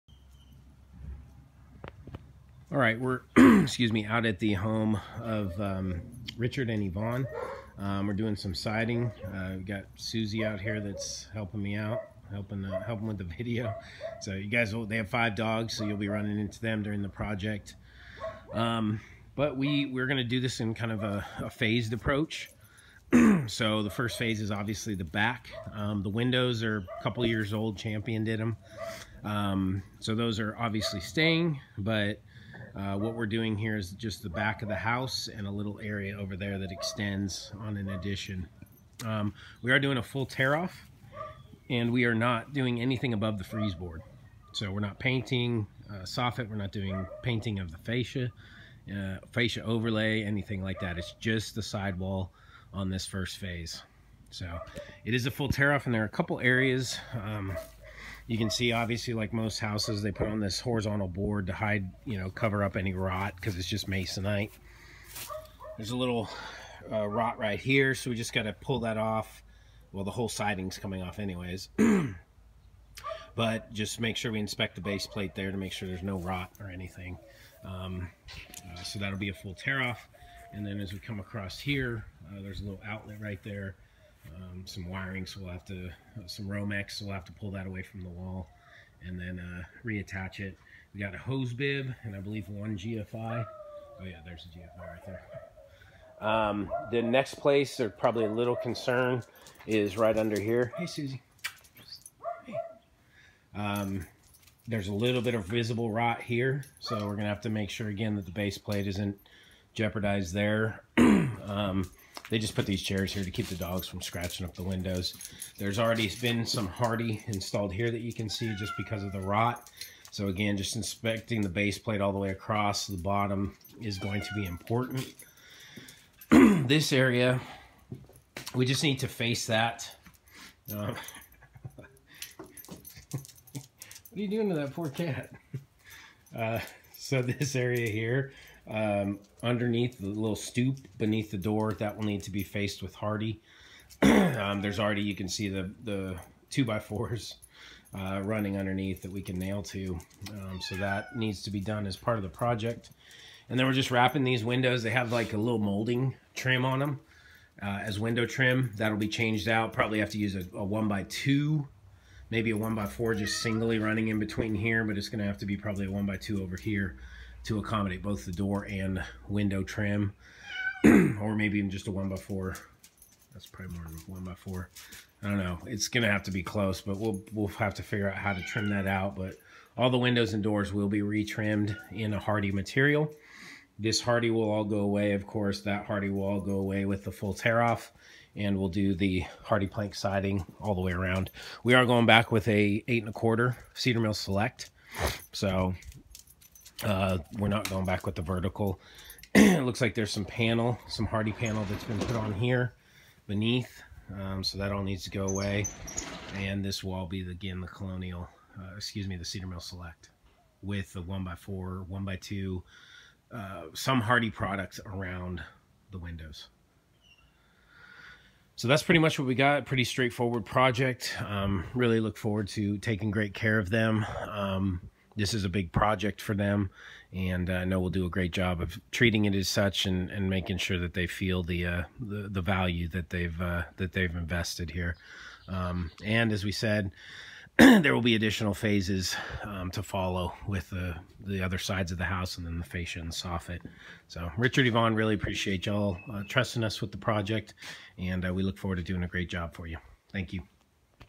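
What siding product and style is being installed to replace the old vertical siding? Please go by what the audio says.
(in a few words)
8 1/4 Cedar Mill Select.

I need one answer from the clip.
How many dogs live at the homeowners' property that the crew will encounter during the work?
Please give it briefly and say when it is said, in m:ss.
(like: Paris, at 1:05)
5, at 0:15.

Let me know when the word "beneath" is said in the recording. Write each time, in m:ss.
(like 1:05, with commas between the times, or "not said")
2:20, 3:23.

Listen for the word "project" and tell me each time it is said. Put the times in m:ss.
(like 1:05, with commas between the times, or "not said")
0:17, 2:32, 3:40, 3:45, 4:06.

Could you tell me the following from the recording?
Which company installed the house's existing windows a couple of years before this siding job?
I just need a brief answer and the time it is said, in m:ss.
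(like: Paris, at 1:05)
Champion, at 0:27.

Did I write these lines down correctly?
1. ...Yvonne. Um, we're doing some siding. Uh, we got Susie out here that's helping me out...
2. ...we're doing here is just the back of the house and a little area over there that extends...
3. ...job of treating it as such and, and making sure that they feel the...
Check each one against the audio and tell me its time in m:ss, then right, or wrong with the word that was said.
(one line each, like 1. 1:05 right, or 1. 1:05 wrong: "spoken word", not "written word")
1. 0:06 right
2. 0:33 right
3. 3:48 right.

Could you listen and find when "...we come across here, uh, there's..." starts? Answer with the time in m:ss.
1:20.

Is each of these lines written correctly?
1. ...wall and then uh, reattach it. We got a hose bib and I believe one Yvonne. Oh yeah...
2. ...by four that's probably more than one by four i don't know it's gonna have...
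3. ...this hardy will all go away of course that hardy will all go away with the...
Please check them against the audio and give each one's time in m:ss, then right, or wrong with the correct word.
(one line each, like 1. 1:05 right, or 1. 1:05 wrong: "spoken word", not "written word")
1. 1:28 wrong: "GFI", not "Yvonne"
2. 2:52 right
3. 3:03 right.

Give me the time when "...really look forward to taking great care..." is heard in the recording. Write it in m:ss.
3:41.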